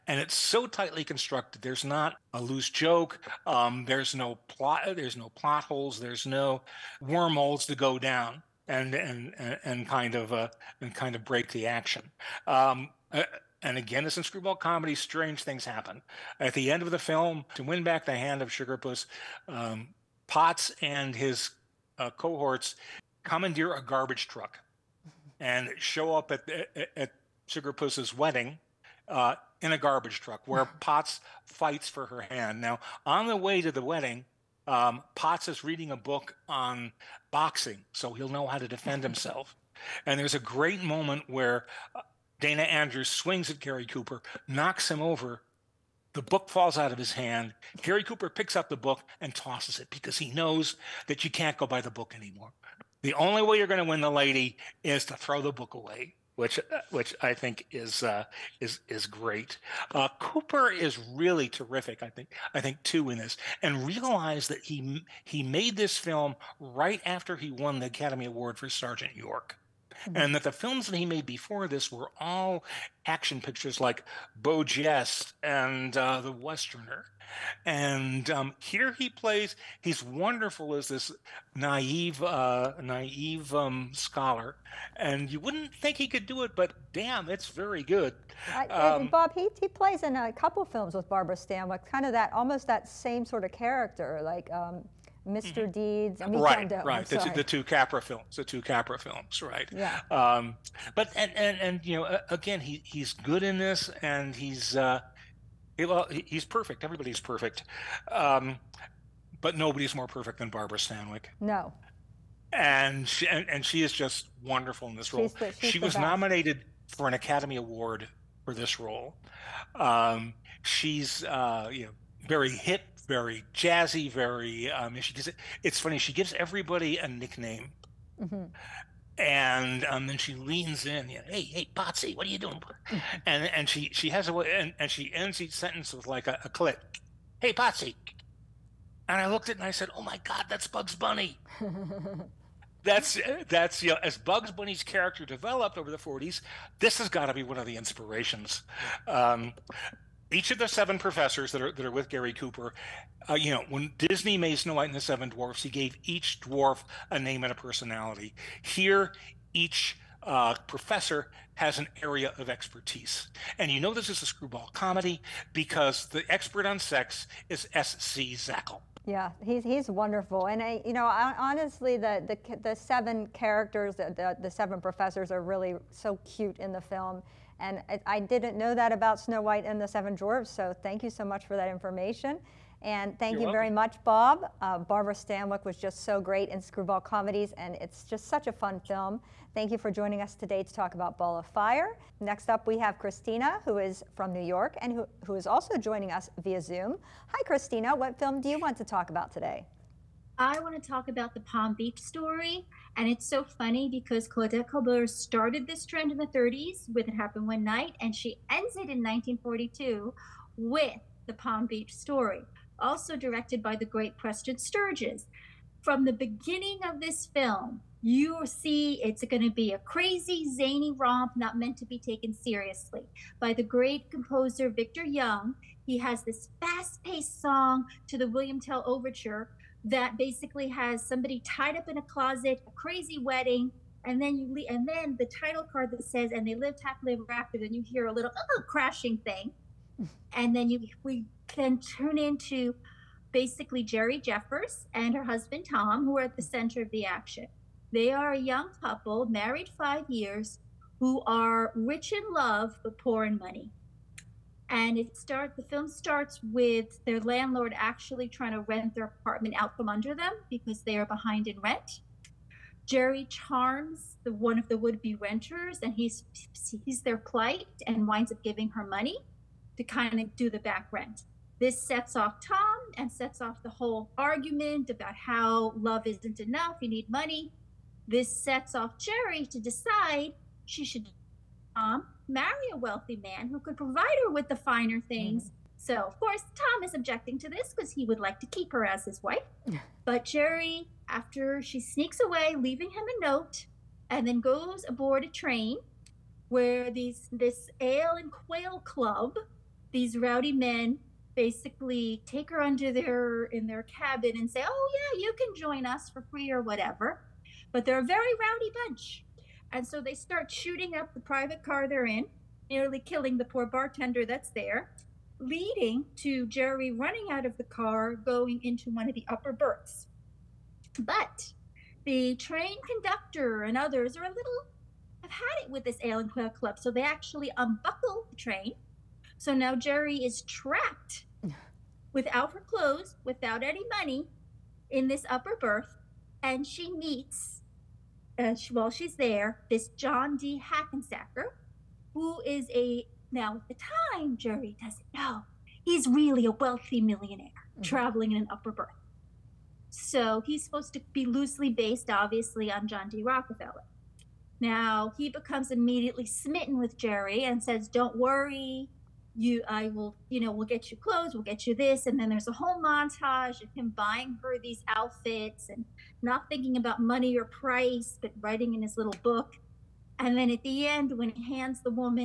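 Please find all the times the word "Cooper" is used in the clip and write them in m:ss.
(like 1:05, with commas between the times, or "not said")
0:43, 0:48, 1:00, 2:32.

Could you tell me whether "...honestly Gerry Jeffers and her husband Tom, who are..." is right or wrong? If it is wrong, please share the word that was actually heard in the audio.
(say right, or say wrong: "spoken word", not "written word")
wrong: "basically", not "honestly".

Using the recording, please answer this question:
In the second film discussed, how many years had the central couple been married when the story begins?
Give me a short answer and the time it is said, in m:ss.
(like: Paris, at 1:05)
5, at 4:09.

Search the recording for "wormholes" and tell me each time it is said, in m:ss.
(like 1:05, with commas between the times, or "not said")
0:07.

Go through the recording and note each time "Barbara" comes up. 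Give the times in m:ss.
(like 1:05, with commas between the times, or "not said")
1:31, 1:50, 3:04.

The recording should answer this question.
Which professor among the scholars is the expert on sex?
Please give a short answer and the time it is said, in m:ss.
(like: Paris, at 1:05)
S. C. Zackle, at 2:47.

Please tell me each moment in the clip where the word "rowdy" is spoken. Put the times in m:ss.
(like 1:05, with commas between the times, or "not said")
5:00, 5:08.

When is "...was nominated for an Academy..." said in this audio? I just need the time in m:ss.
1:55.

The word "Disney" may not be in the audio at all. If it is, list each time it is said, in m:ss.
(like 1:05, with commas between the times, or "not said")
2:33.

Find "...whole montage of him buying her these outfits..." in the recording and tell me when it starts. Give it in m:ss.
6:02.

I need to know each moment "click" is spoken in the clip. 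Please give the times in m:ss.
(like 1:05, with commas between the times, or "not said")
2:16.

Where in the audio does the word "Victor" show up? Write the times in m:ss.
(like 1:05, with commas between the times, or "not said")
3:44.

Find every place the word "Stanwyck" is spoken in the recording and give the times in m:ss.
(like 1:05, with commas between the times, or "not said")
1:31, 1:50, 3:05.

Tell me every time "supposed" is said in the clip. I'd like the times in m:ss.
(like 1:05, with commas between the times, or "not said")
5:50.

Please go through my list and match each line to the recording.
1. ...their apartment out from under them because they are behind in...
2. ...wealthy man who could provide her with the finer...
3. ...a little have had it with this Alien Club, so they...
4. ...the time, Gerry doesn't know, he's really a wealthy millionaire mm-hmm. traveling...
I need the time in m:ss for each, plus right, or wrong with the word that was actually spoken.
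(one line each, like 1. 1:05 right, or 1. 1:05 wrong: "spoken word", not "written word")
1. 4:18 right
2. 4:42 right
3. 5:24 right
4. 5:43 right.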